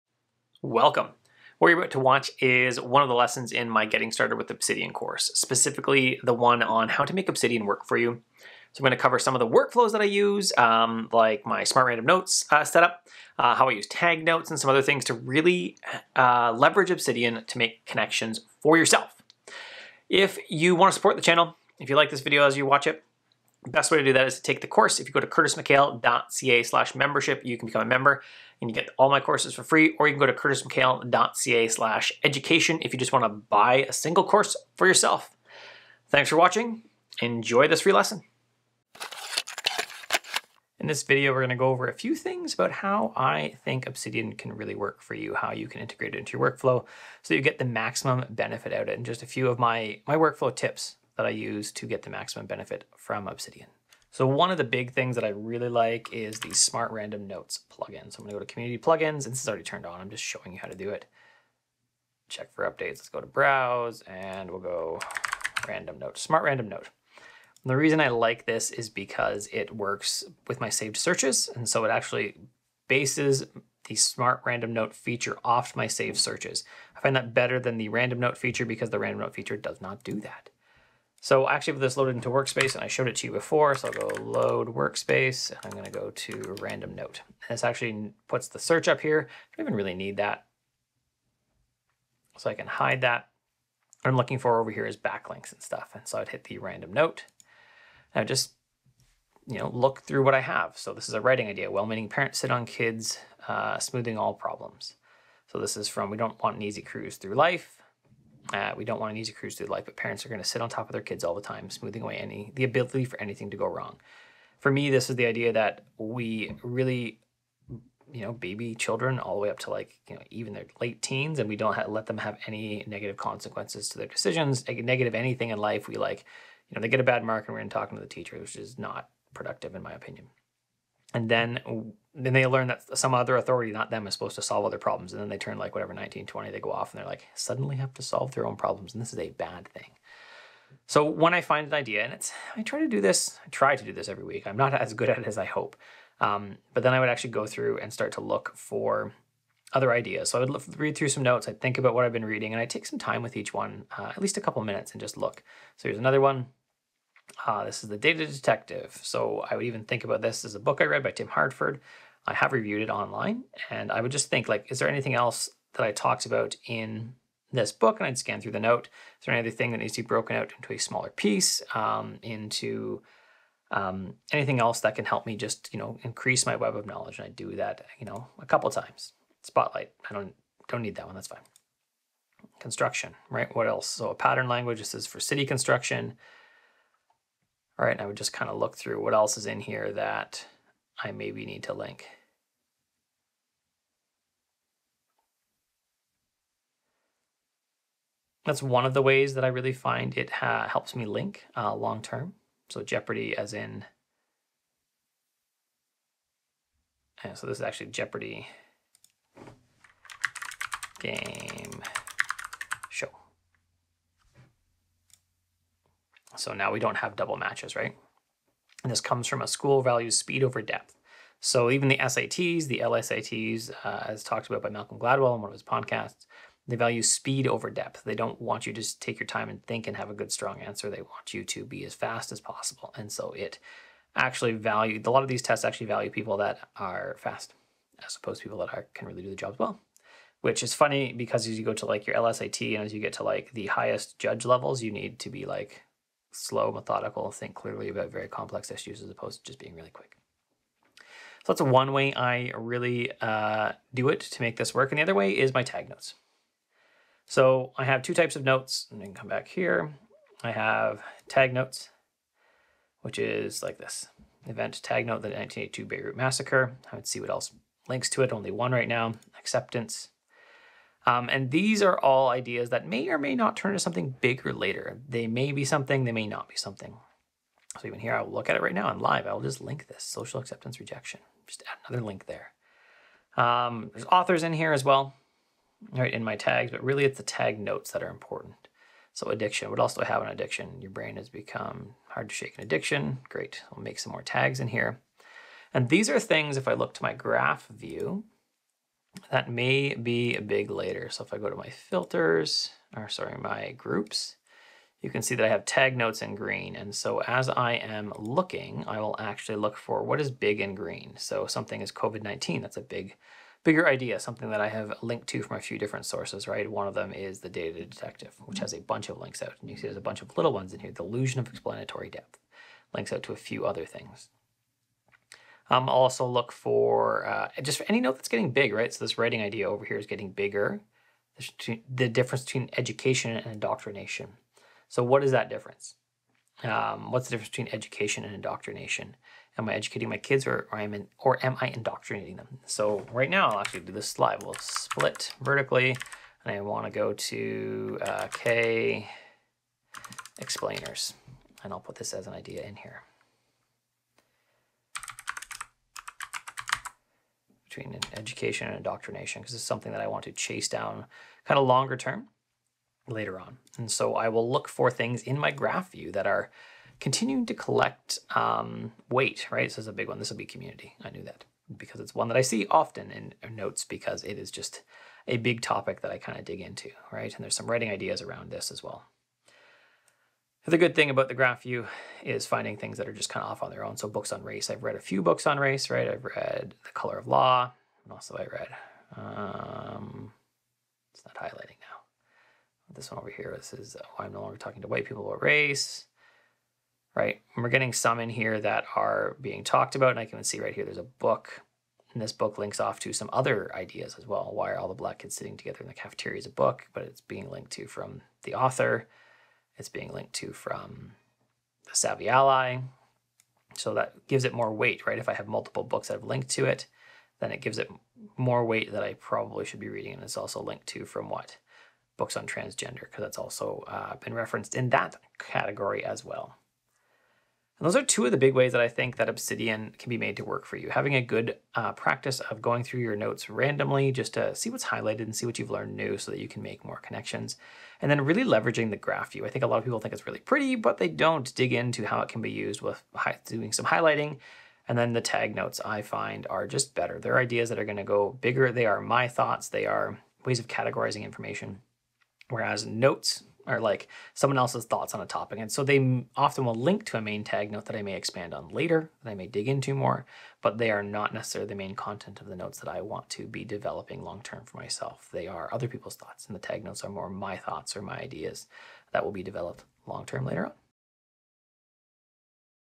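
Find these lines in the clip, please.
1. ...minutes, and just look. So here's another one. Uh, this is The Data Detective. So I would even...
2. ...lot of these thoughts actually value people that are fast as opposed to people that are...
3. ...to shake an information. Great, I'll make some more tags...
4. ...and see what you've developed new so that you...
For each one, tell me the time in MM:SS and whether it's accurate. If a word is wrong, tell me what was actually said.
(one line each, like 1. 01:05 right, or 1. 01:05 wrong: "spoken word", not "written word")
1. 02:34 right
2. 03:55 wrong: "tests", not "thoughts"
3. 04:52 wrong: "addiction", not "information"
4. 07:15 wrong: "learned", not "developed".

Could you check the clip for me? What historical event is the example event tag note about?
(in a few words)
1982 Beirut massacre.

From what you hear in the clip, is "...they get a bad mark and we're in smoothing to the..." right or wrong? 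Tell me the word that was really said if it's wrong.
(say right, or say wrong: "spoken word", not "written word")
wrong: "talking", not "smoothing".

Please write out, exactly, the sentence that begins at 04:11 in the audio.
So that's one way I really uh, do it to make this work.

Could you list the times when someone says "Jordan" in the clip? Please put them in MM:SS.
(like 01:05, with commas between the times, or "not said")
not said.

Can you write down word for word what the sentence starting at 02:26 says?
Um, but then I would actually go through and start to look for other ideas.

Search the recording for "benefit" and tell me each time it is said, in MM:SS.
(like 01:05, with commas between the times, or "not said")
00:48, 00:52.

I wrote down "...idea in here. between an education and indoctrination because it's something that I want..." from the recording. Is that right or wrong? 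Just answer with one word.
right.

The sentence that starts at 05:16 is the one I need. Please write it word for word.
One of them is the Data Detective, which has a bunch of links out.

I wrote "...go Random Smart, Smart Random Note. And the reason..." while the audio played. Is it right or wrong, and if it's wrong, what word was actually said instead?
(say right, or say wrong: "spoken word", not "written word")
wrong: "Note", not "Smart".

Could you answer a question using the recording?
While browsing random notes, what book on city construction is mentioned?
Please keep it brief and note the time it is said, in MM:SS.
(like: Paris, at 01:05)
A Pattern Language, at 03:04.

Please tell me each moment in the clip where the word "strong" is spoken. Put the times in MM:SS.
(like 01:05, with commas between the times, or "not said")
03:50.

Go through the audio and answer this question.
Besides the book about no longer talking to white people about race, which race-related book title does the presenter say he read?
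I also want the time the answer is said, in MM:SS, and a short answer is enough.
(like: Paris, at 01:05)
The Color of Law, at 06:26.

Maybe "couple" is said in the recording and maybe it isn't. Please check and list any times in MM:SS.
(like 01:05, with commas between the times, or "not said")
02:34, 02:58.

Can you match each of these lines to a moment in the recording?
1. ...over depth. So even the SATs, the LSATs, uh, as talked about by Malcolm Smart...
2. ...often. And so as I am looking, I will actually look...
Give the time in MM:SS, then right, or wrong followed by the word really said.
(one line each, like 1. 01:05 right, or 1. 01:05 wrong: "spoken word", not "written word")
1. 03:40 wrong: "Gladwell", not "Smart"
2. 05:06 wrong: "green", not "often".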